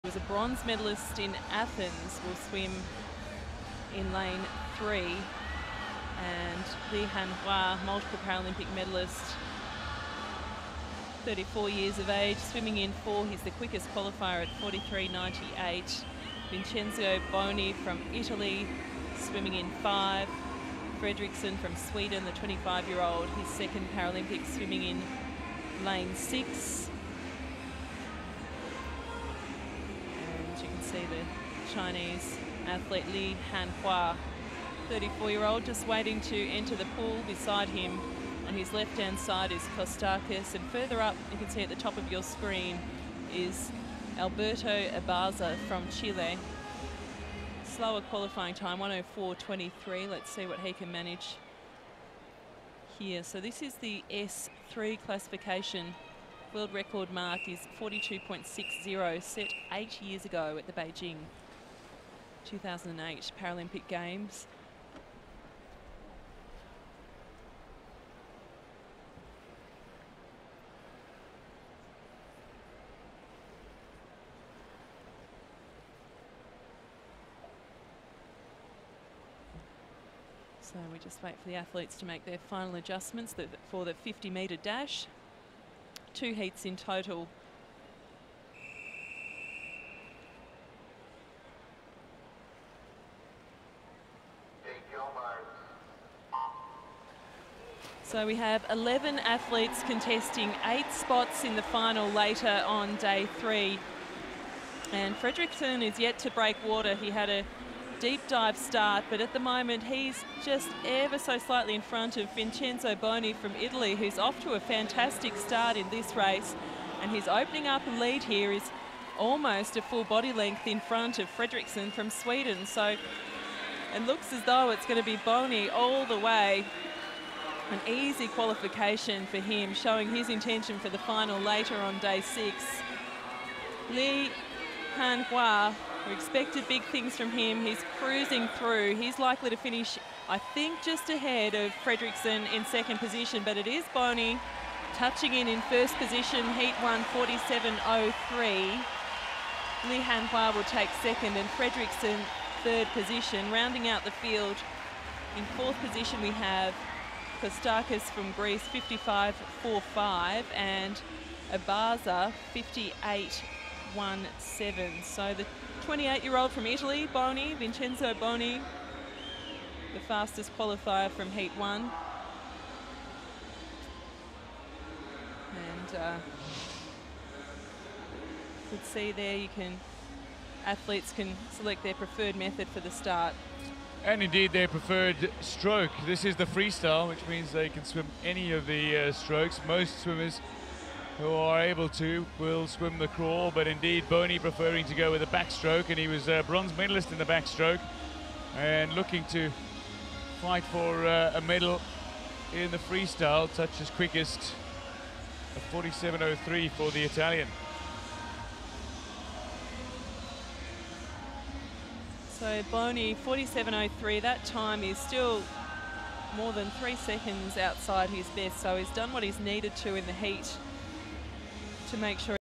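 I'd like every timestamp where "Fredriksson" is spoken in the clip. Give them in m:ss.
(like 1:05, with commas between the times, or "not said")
0:20, 1:45, 2:01, 2:21, 2:31.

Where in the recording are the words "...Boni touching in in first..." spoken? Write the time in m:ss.
2:23.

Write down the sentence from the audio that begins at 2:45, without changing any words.
So the 28-year-old from Italy, Boni, Vincenzo Boni, the fastest qualifier from Heat 1.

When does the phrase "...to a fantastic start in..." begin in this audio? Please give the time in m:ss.
1:54.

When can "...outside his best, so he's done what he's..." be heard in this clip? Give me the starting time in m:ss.
3:37.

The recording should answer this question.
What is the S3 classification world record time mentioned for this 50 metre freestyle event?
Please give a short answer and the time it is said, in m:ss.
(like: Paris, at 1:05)
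42.60, at 0:57.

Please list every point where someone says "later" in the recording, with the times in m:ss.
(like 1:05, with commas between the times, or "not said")
1:42, 2:11.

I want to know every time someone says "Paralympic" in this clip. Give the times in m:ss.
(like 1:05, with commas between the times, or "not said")
0:08, 0:23, 1:03.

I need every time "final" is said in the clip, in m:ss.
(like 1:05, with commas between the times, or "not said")
1:22, 1:41, 2:10.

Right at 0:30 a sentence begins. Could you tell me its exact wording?
see the Chinese athlete Li Hanhua, 34-year-old, just waiting to enter the pool beside him.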